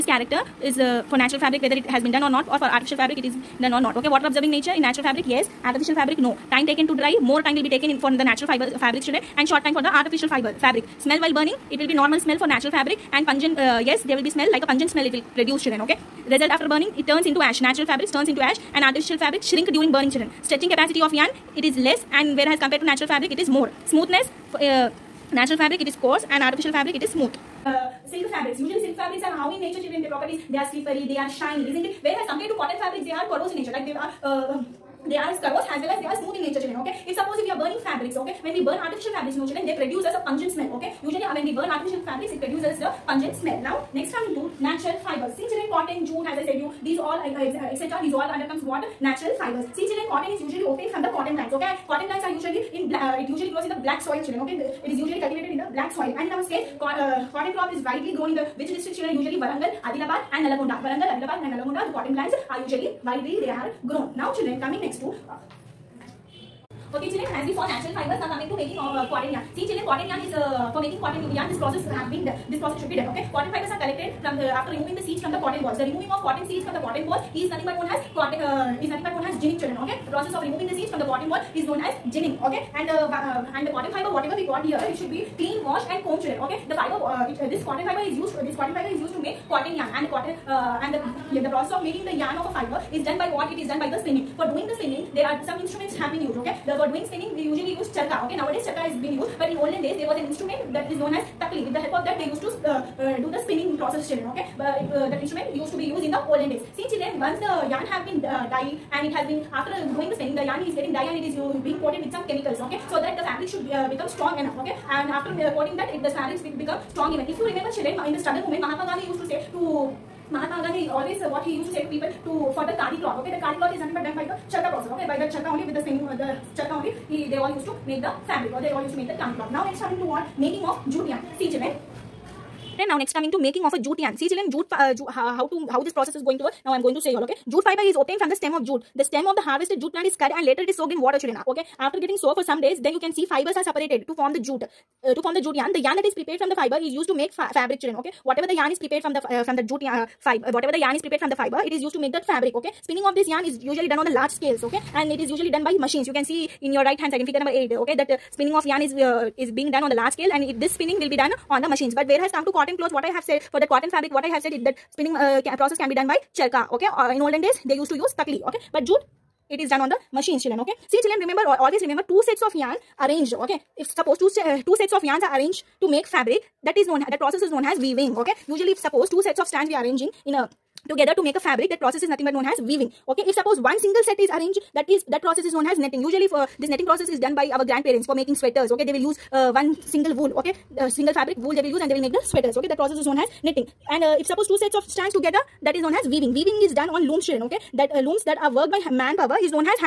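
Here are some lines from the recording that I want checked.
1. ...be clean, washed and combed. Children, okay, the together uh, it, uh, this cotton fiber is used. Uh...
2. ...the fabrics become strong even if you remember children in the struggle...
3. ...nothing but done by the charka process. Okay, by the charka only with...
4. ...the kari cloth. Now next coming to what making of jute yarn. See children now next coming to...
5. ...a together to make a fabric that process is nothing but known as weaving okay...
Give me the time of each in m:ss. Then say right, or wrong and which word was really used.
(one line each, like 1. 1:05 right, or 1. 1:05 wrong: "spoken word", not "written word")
1. 1:25 wrong: "fiber", not "together"
2. 1:56 right
3. 2:03 right
4. 2:09 right
5. 3:00 right.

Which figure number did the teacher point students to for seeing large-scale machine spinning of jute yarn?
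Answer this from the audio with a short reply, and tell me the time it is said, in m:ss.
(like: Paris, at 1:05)
8, at 2:37.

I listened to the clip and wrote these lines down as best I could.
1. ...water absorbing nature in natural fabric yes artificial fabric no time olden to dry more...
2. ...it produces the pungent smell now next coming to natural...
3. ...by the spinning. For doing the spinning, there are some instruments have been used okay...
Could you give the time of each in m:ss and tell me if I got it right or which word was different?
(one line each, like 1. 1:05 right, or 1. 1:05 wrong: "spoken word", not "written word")
1. 0:04 wrong: "taken", not "olden"
2. 0:42 right
3. 1:33 right.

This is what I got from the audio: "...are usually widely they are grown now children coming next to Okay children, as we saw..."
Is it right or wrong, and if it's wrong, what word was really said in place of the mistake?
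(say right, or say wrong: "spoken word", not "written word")
right.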